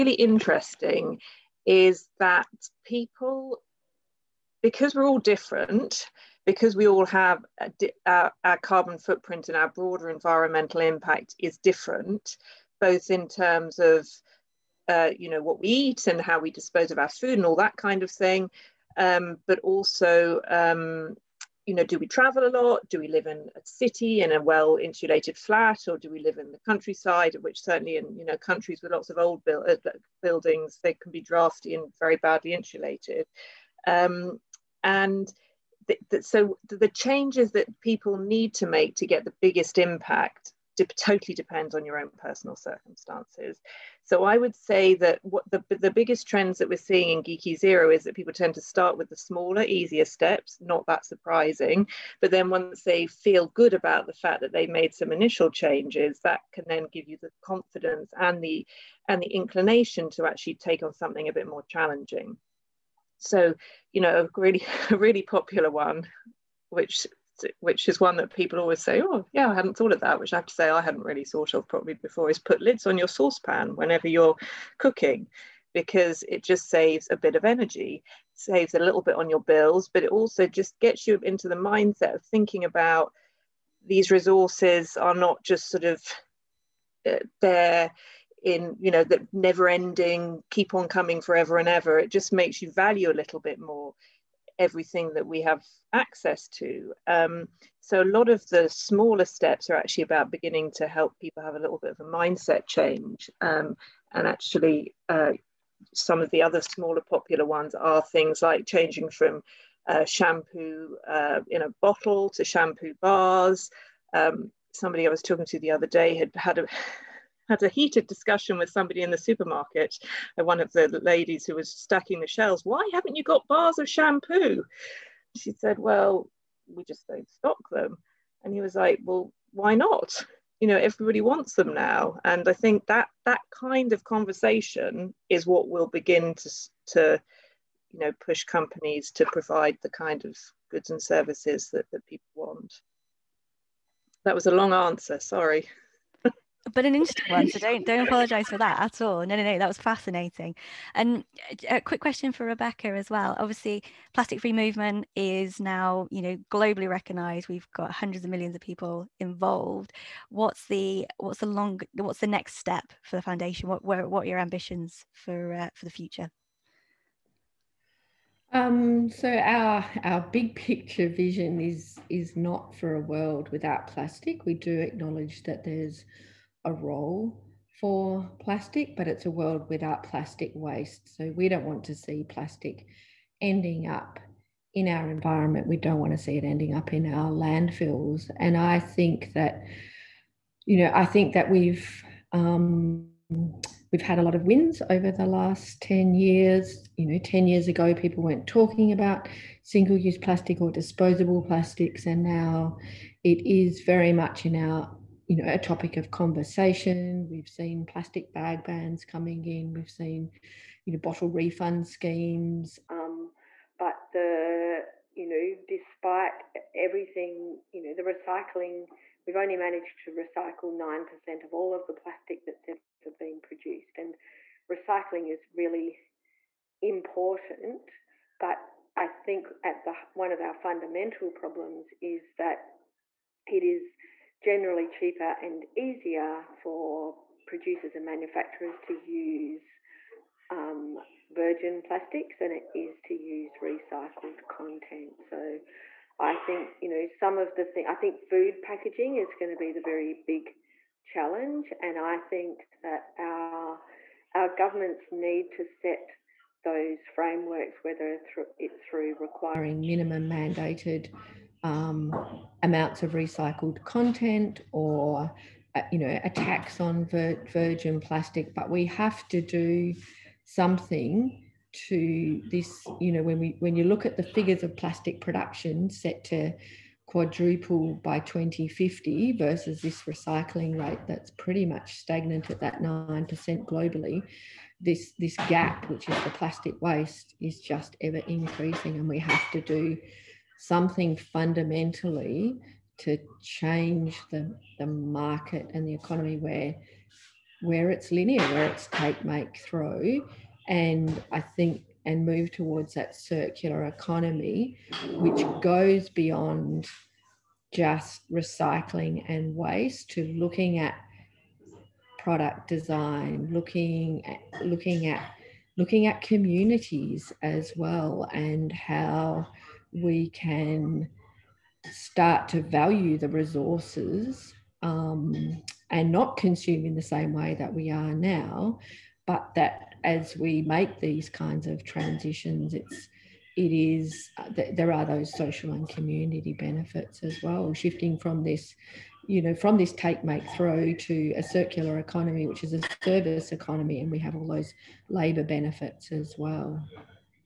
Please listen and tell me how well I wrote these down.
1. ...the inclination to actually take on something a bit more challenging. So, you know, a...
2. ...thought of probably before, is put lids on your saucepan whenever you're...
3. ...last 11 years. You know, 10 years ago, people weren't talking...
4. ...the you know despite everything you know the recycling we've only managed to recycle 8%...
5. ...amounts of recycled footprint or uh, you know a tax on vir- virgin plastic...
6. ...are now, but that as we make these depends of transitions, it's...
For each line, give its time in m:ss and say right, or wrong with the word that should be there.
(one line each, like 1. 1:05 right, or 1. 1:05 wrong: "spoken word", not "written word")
1. 0:59 right
2. 1:11 right
3. 3:15 wrong: "10", not "11"
4. 3:34 wrong: "9", not "8"
5. 4:22 wrong: "content", not "footprint"
6. 5:27 wrong: "kinds", not "depends".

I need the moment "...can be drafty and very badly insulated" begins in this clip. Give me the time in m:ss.
0:30.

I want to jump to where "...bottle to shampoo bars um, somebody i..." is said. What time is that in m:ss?
1:51.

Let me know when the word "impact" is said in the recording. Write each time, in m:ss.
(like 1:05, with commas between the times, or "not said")
0:10, 0:39.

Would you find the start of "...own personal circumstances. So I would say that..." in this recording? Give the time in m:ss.
0:41.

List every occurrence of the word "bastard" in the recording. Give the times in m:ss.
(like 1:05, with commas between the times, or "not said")
not said.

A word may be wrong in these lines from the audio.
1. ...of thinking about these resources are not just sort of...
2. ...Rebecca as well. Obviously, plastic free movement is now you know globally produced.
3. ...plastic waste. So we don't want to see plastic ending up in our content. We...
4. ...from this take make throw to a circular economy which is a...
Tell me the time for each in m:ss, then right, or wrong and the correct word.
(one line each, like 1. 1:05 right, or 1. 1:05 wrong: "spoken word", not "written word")
1. 1:22 right
2. 2:32 wrong: "recognised", not "produced"
3. 3:00 wrong: "environment", not "content"
4. 5:39 right.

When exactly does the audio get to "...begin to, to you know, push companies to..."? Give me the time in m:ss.
2:15.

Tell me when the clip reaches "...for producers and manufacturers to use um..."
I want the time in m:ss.
3:56.